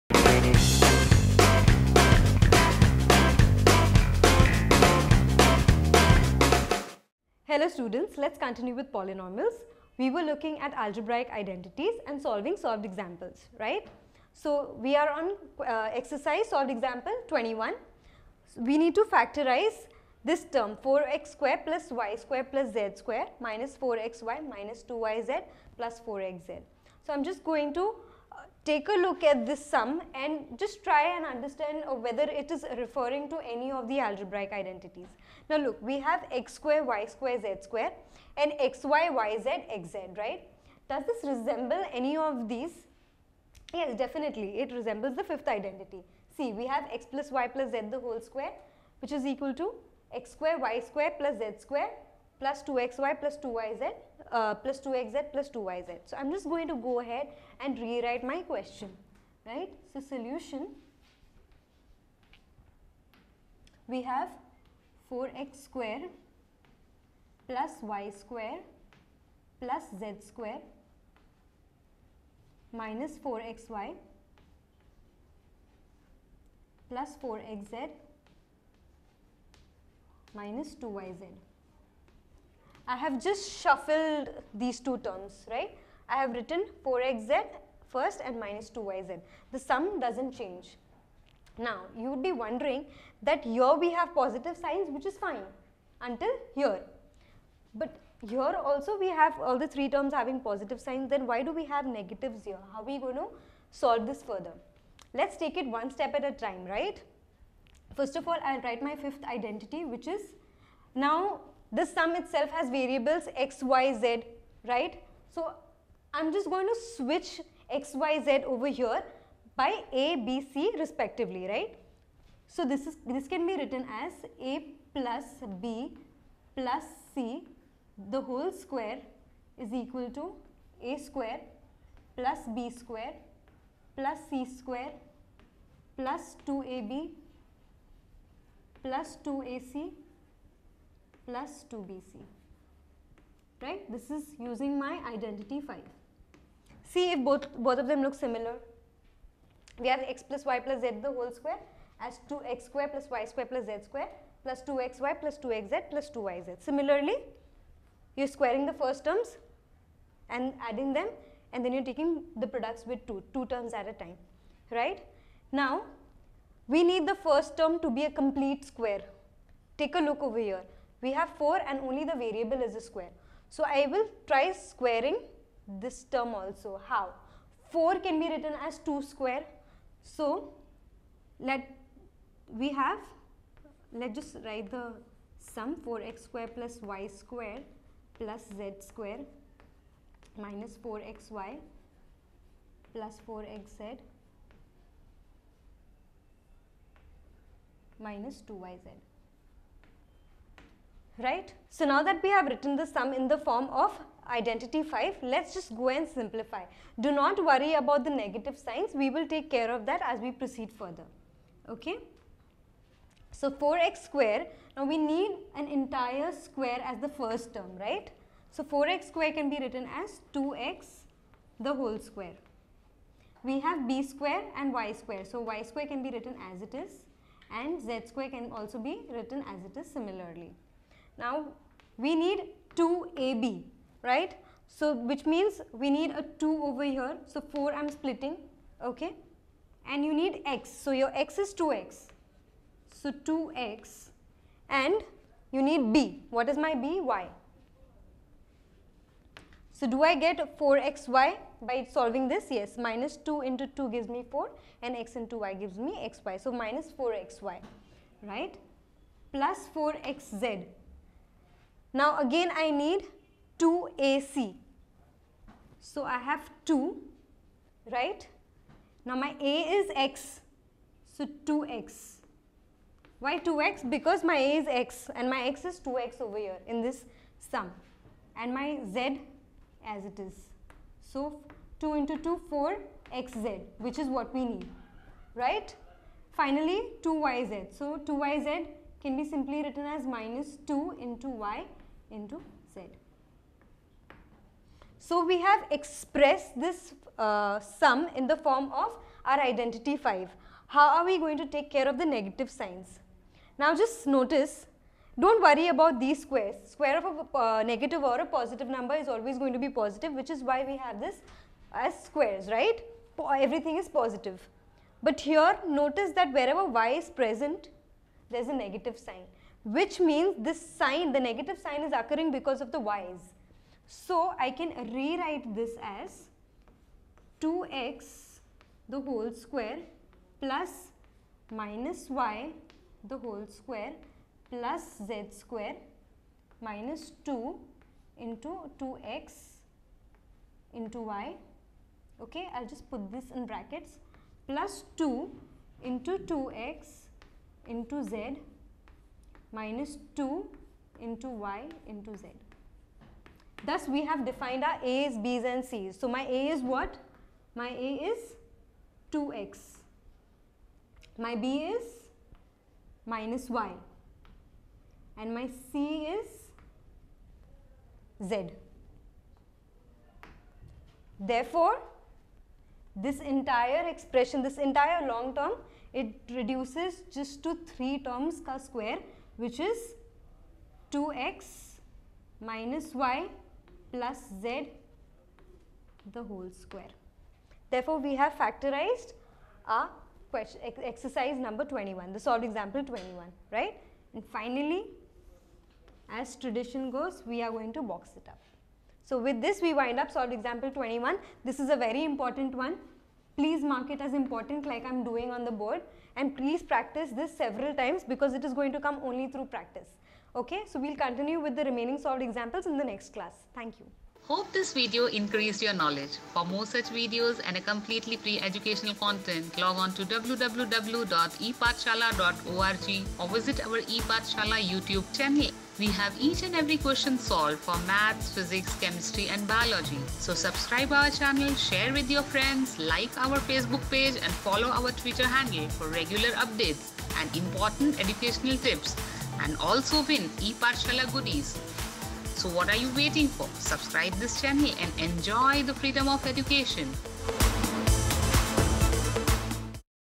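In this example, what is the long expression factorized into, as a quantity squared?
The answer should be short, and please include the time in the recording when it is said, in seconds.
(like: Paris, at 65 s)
2x minus y plus z, at 380 s.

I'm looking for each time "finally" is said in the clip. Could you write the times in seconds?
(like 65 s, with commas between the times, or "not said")
286 s, 394 s.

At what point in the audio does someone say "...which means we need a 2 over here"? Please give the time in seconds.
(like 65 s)
234 s.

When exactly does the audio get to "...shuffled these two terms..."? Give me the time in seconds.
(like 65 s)
83 s.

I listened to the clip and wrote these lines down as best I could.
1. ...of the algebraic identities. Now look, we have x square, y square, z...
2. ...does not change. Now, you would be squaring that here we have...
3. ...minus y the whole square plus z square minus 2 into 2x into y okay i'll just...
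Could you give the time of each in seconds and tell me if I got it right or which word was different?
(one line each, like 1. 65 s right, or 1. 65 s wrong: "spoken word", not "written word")
1. 33 s right
2. 89 s wrong: "wondering", not "squaring"
3. 331 s right.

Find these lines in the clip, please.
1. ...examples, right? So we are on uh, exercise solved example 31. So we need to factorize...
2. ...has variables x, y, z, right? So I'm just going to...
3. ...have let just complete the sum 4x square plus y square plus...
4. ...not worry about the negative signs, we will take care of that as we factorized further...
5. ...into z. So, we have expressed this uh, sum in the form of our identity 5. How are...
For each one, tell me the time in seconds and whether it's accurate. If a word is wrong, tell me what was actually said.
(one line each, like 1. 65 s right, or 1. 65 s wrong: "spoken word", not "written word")
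1. 12 s wrong: "21", not "31"
2. 112 s right
3. 182 s wrong: "write", not "complete"
4. 207 s wrong: "proceed", not "factorized"
5. 292 s right.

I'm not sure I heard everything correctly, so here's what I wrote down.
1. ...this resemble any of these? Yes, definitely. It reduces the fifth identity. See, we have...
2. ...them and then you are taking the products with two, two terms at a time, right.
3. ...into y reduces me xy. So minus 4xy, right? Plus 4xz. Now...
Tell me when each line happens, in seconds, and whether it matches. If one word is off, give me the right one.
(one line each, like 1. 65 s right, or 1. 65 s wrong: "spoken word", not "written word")
1. 41 s wrong: "resembles", not "reduces"
2. 160 s right
3. 255 s wrong: "gives", not "reduces".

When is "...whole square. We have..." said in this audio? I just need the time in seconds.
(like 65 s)
221 s.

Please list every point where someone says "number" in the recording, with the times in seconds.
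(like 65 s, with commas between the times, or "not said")
308 s, 391 s.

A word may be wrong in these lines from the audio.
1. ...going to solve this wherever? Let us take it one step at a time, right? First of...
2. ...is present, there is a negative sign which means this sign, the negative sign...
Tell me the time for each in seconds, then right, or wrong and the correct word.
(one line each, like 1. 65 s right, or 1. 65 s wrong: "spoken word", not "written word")
1. 102 s wrong: "further", not "wherever"
2. 316 s right.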